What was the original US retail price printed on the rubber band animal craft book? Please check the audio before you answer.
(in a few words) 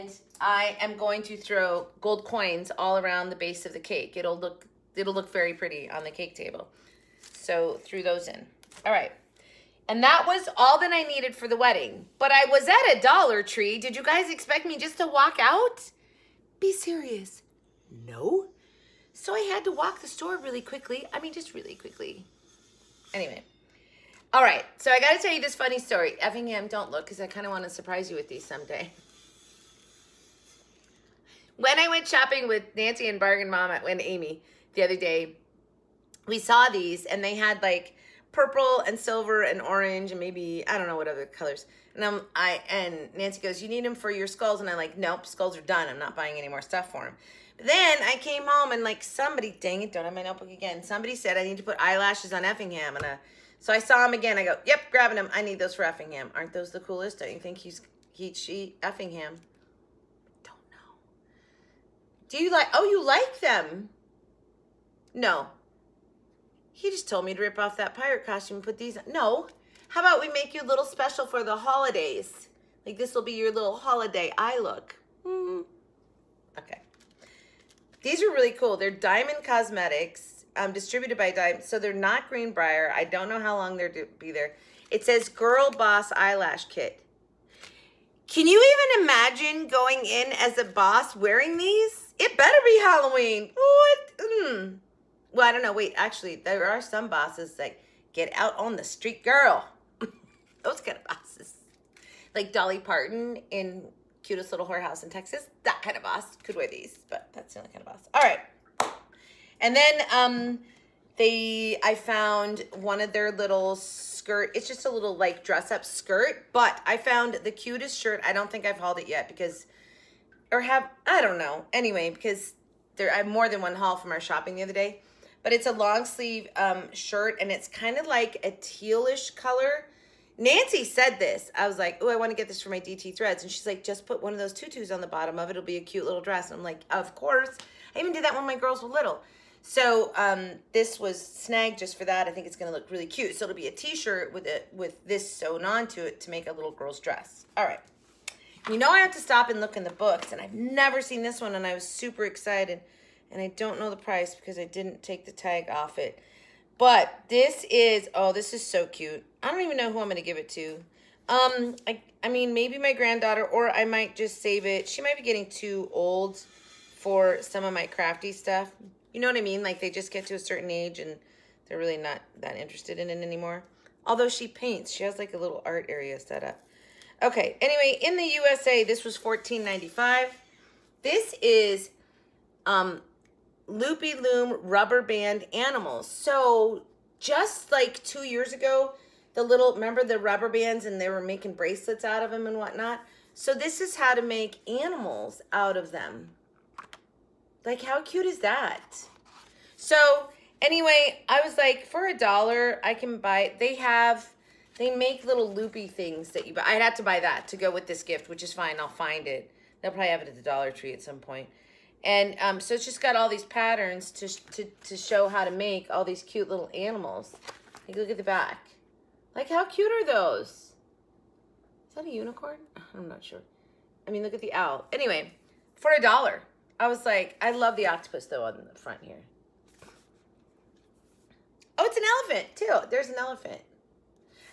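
$14.95.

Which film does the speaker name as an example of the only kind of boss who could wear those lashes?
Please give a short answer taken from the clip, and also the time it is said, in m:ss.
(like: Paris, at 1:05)
Cutest Little Whorehouse in Texas, at 1:44.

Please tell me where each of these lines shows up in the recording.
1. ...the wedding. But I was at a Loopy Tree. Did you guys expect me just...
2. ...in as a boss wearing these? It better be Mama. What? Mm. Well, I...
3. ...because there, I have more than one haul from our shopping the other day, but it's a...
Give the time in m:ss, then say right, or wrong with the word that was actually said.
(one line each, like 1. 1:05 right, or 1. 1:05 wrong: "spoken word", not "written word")
1. 0:11 wrong: "Dollar", not "Loopy"
2. 1:30 wrong: "Halloween", not "Mama"
3. 2:02 right.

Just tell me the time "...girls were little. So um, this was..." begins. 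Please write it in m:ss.
2:18.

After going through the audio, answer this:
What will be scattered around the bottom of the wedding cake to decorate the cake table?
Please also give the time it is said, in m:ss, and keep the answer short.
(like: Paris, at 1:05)
gold coins, at 0:02.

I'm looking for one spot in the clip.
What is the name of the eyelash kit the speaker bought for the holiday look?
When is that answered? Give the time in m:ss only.
1:25.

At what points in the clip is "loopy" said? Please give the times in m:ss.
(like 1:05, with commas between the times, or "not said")
3:03, 3:25.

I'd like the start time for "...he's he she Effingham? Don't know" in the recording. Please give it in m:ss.
0:57.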